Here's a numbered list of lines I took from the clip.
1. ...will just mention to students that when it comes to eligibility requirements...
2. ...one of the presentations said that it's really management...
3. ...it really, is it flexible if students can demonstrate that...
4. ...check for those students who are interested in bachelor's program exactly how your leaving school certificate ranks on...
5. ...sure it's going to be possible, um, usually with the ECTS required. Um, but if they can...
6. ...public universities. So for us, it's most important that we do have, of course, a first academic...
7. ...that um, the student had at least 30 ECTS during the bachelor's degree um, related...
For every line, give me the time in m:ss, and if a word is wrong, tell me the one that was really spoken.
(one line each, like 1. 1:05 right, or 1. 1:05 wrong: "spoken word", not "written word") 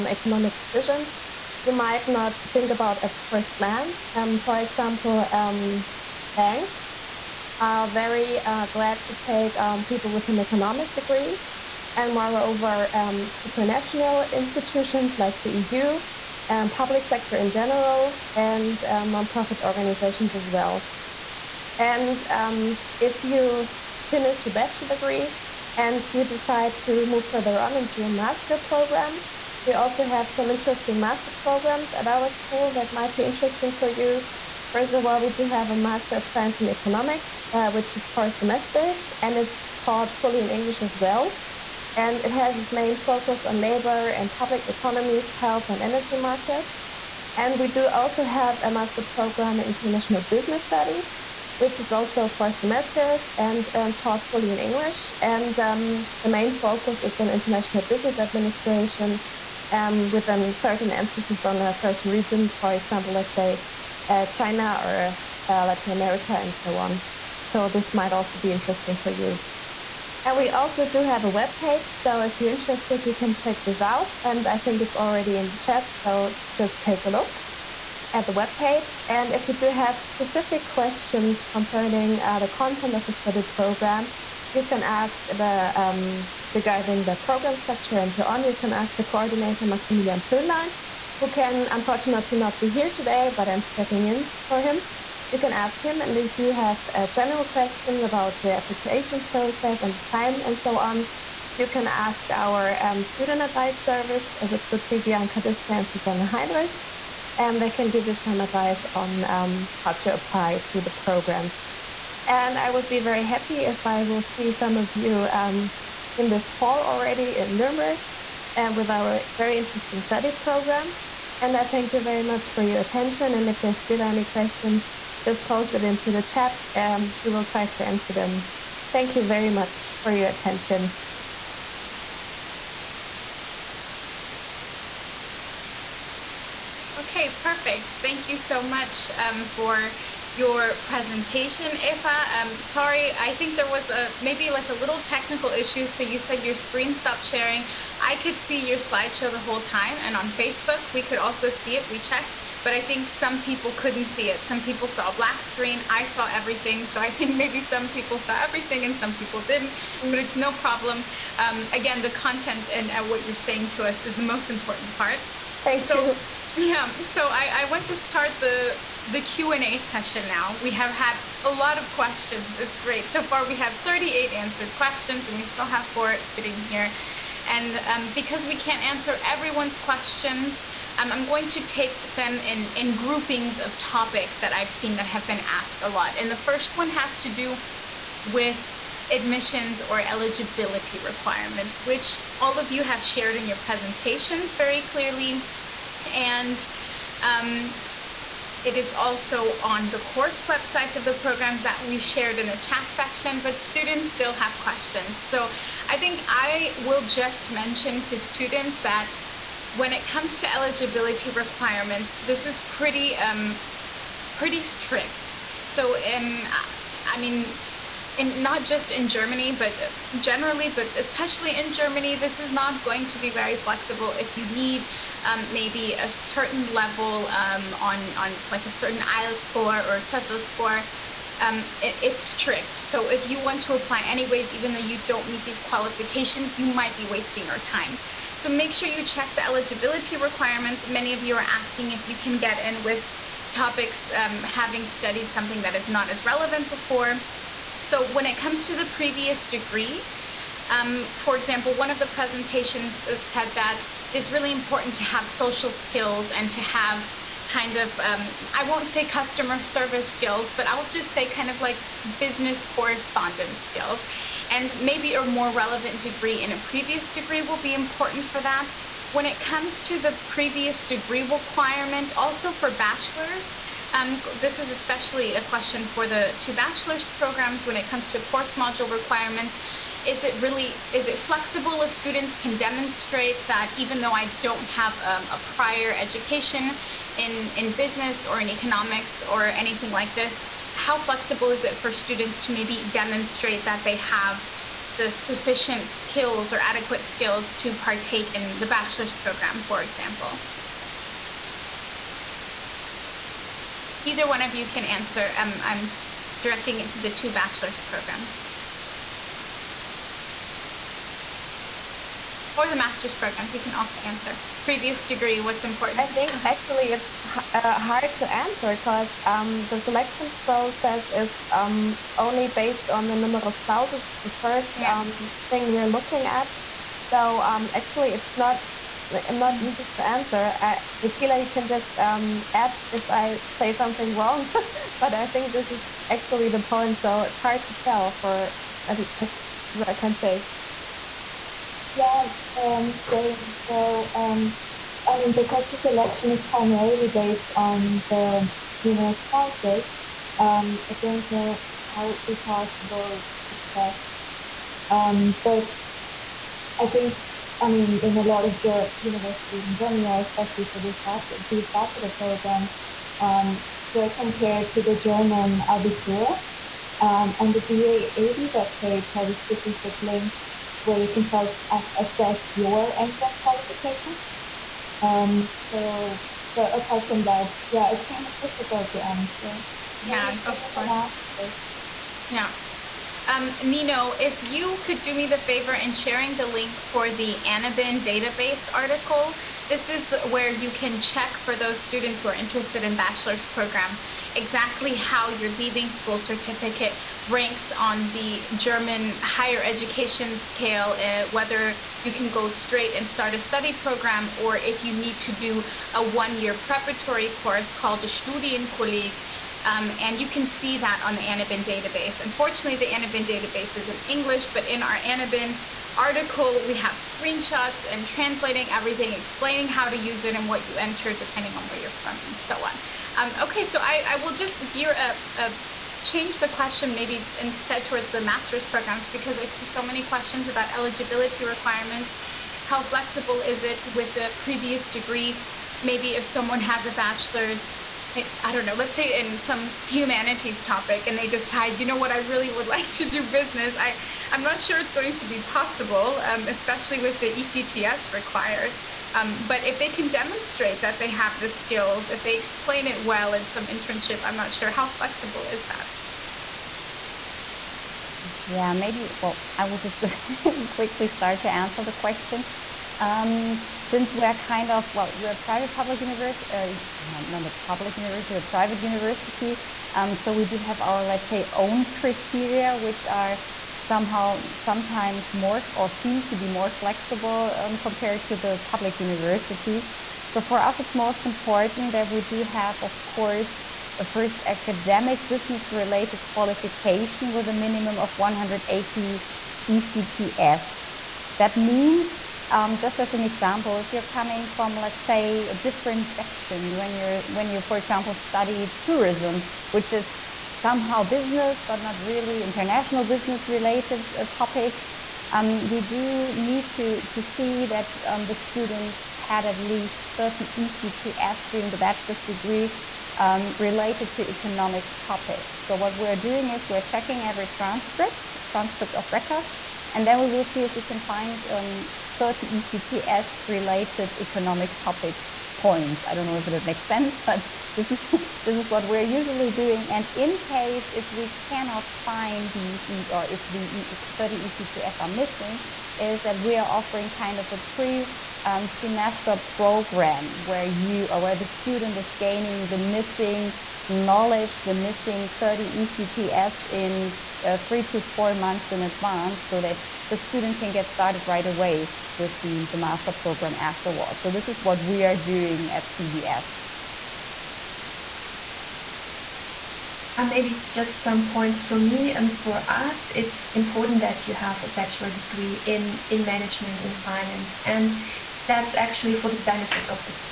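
1. 3:26 right
2. 4:11 wrong: "important", not "management"
3. 4:40 right
4. 6:31 right
5. 7:24 wrong: "especially", not "usually"
6. 7:58 right
7. 8:27 right.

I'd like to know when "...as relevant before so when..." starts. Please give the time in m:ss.
4:06.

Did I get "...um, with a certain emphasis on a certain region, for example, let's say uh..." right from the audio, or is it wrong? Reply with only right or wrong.
right.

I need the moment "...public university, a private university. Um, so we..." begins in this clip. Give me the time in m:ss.
7:47.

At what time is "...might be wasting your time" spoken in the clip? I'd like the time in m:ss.
3:56.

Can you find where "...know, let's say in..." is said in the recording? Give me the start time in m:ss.
7:18.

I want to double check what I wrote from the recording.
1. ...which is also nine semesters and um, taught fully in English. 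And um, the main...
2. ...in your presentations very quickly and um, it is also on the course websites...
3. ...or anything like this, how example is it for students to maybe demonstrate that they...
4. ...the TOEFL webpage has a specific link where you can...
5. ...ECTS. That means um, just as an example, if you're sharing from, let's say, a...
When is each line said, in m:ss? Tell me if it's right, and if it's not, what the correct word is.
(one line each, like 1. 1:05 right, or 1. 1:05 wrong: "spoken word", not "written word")
1. 0:51 wrong: "four", not "nine"
2. 3:13 wrong: "clearly", not "quickly"
3. 4:49 wrong: "flexible", not "example"
4. 6:07 wrong: "DAAD", not "TOEFL"
5. 8:09 wrong: "coming", not "sharing".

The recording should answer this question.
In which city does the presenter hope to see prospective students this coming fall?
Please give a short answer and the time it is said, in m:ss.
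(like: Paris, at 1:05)
Nuremberg, at 1:57.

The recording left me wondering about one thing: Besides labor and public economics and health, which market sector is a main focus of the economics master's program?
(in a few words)
Energy markets.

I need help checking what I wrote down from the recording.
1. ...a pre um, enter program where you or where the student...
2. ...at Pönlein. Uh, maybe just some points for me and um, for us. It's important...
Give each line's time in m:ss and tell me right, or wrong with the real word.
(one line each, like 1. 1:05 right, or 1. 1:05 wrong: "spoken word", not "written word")
1. 8:57 wrong: "semester", not "enter"
2. 9:15 wrong: "CBS", not "Pönlein".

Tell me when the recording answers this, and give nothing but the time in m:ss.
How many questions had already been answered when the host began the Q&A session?
2:53.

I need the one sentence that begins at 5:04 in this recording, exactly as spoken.
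Either one of you can answer.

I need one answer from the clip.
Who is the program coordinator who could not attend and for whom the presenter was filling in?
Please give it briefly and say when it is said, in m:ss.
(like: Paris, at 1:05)
Maximilian Pönlein, at 1:29.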